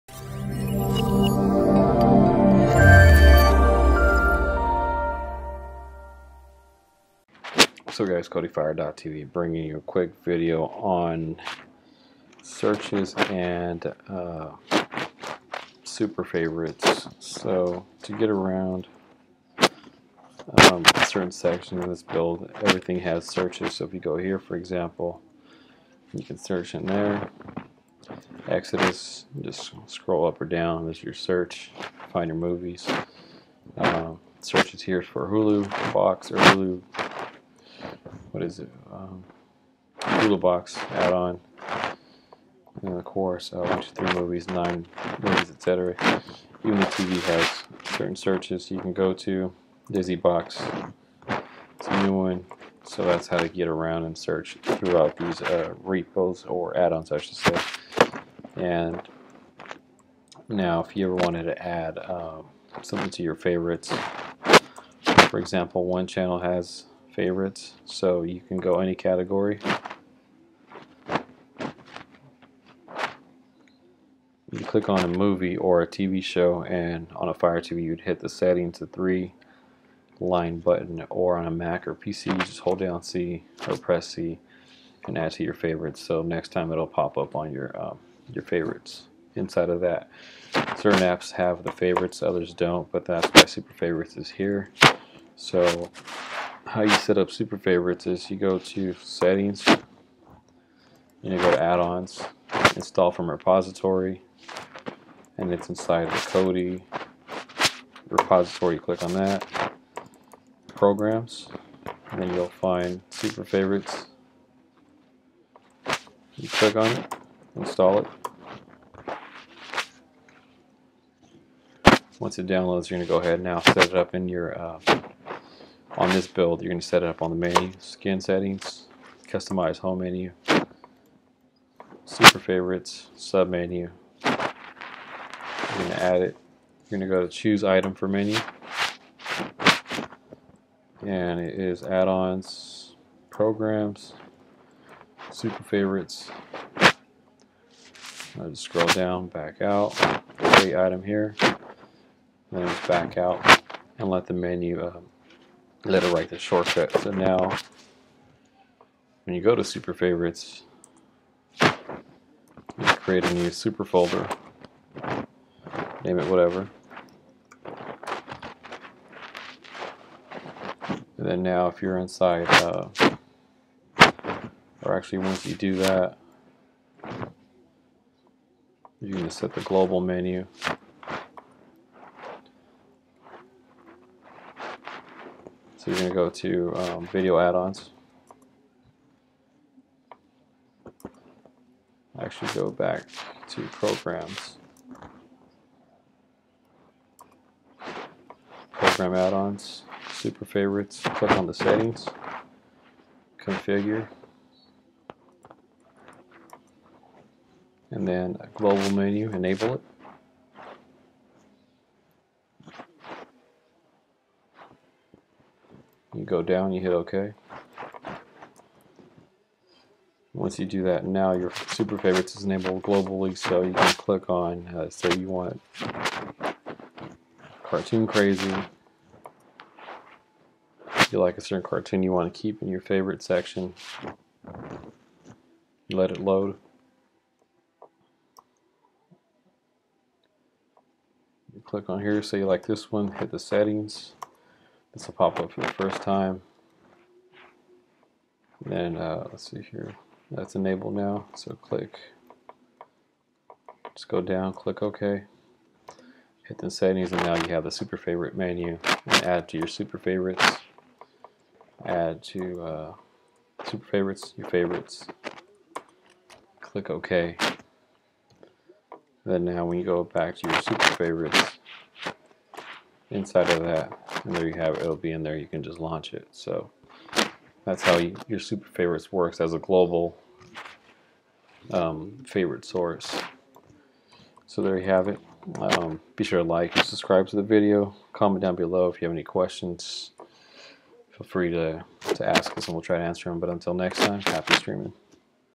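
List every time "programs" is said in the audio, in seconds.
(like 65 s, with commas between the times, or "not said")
110 s, 143 s, 193 s, 198 s.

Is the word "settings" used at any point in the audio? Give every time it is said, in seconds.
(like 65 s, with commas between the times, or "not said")
78 s, 99 s, 128 s, 201 s, 243 s, 256 s.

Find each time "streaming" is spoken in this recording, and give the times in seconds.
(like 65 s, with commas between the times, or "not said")
294 s.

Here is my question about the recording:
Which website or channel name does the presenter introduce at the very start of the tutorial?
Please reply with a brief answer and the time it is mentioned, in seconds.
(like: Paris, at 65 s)
KodiFire.tv, at 8 s.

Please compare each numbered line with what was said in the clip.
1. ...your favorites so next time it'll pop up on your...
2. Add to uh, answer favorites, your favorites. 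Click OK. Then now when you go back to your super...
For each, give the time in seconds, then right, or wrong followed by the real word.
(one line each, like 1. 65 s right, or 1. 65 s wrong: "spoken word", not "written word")
1. 85 s right
2. 261 s wrong: "super", not "answer".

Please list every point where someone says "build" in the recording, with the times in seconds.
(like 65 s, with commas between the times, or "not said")
22 s, 126 s.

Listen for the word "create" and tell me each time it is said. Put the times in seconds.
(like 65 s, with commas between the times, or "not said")
150 s, 162 s.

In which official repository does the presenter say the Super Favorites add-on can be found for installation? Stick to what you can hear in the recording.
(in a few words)
Kodi repository.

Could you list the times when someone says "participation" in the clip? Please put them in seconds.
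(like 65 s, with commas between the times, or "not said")
not said.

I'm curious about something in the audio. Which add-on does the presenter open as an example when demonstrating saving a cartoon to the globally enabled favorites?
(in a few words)
Cartoon Crazy.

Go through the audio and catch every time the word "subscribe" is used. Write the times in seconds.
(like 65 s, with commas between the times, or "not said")
286 s.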